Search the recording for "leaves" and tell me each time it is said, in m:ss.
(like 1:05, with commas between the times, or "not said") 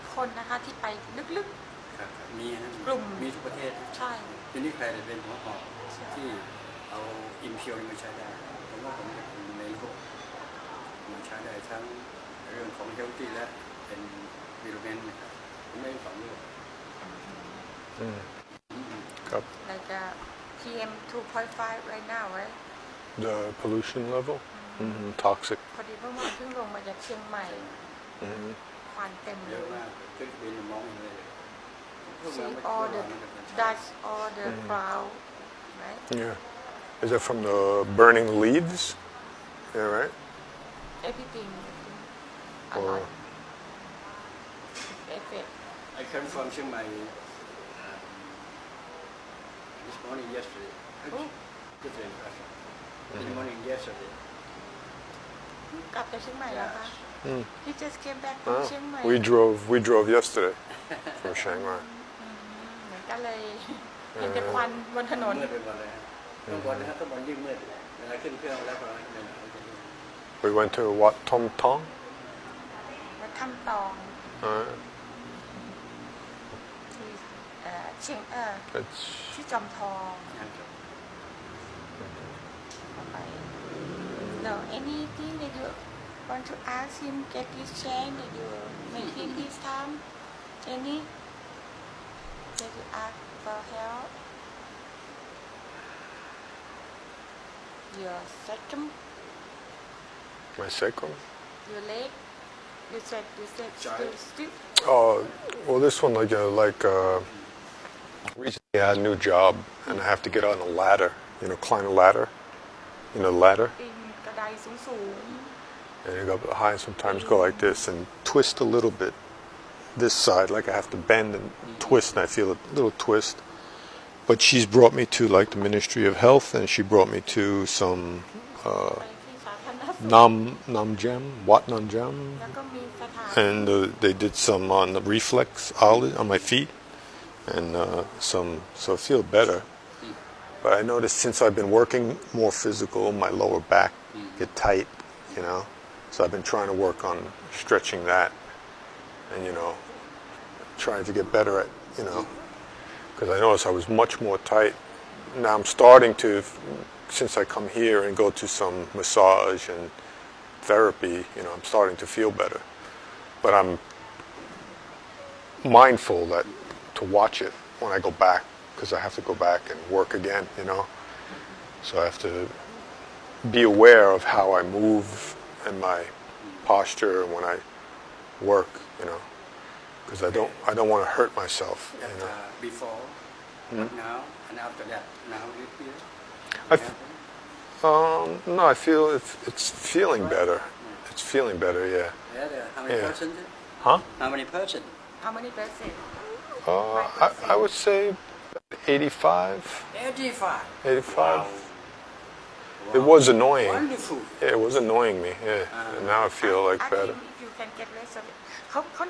0:38.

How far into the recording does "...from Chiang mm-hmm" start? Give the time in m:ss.
1:01.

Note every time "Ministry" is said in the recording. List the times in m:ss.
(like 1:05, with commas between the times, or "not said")
2:05.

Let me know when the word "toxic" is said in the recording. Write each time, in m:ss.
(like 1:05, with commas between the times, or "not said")
0:25.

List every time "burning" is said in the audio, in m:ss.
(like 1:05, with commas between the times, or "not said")
0:37.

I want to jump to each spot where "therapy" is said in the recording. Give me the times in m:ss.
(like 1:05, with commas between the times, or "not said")
2:40.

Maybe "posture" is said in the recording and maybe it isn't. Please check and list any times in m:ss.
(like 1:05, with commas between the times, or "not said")
2:56.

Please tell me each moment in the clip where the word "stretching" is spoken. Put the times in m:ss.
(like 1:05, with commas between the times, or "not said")
2:27.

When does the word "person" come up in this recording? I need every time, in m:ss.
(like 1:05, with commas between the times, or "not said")
0:52, 3:14.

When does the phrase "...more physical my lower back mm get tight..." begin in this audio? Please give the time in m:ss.
2:22.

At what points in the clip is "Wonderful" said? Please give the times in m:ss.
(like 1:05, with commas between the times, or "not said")
3:23.